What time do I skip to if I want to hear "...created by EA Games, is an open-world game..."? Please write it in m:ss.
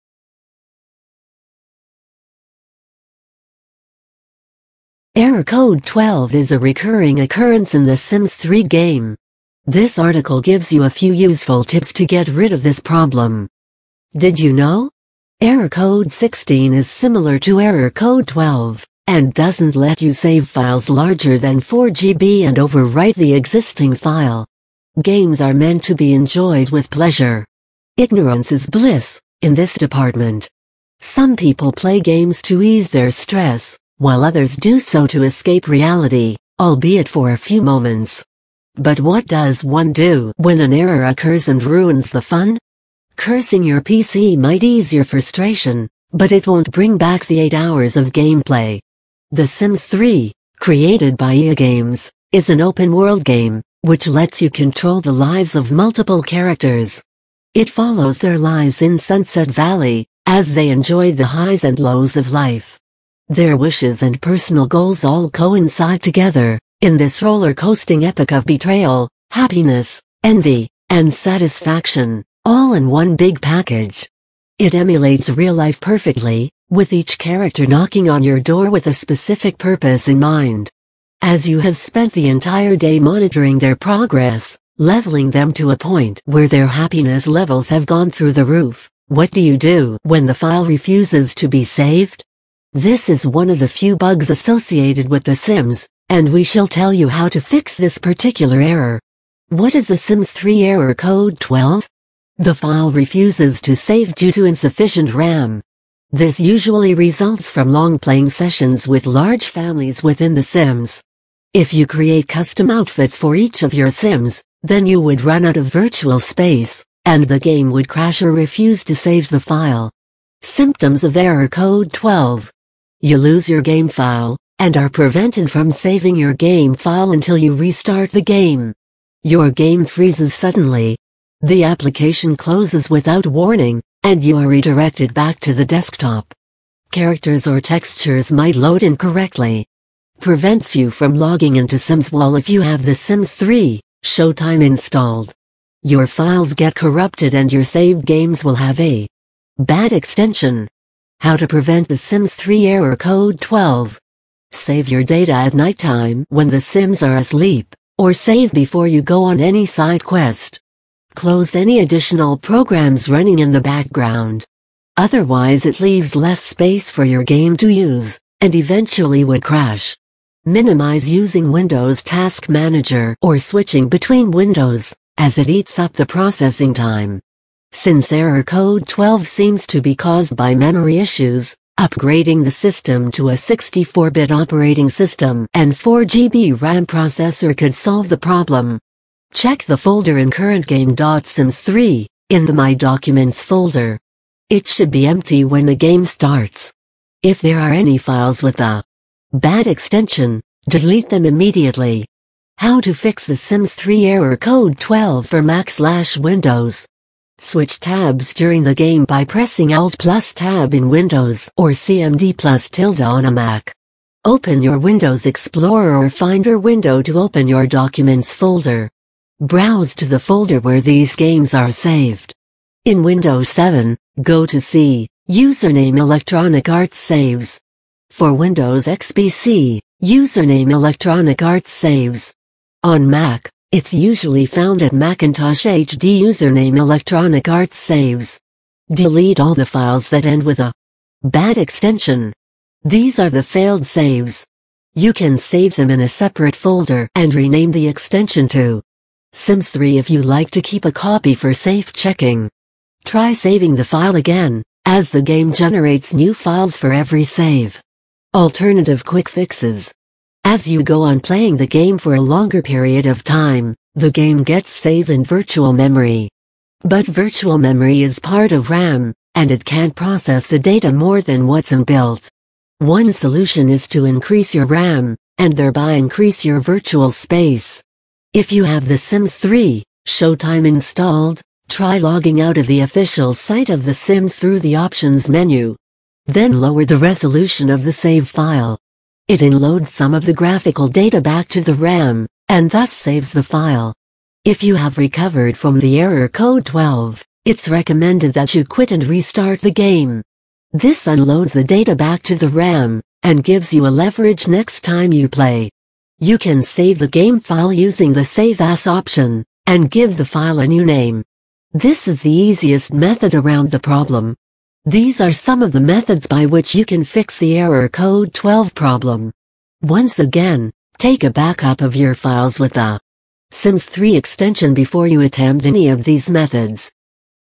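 0:50.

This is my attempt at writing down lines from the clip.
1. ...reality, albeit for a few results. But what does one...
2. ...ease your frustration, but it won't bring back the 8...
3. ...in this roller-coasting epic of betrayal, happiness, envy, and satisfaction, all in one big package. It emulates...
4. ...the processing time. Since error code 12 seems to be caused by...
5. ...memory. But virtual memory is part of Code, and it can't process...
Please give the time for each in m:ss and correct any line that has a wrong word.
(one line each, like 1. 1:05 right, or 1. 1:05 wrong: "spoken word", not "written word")
1. 0:35 wrong: "moments", not "results"
2. 0:44 right
3. 1:06 right
4. 2:55 right
5. 4:25 wrong: "RAM", not "Code".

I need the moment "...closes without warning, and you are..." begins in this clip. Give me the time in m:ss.
2:12.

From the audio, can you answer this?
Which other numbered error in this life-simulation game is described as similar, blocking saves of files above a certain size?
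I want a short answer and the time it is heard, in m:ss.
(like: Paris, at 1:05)
Error code 16, at 0:15.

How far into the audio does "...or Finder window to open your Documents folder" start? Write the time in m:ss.
3:35.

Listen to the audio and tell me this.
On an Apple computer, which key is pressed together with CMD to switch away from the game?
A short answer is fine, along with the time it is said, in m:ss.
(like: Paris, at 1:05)
Tilde, at 3:32.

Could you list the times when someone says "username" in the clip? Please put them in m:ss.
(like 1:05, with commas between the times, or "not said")
3:45, 3:50, 3:56.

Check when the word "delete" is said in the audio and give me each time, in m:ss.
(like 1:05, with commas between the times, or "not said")
3:20, 3:58.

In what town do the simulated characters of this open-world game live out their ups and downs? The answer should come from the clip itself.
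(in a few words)
Sunset Valley.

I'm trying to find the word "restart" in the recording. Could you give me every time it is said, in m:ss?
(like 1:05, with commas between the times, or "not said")
2:07, 4:59.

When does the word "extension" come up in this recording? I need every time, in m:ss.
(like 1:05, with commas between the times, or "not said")
2:29, 3:19, 4:01, 4:07, 5:24.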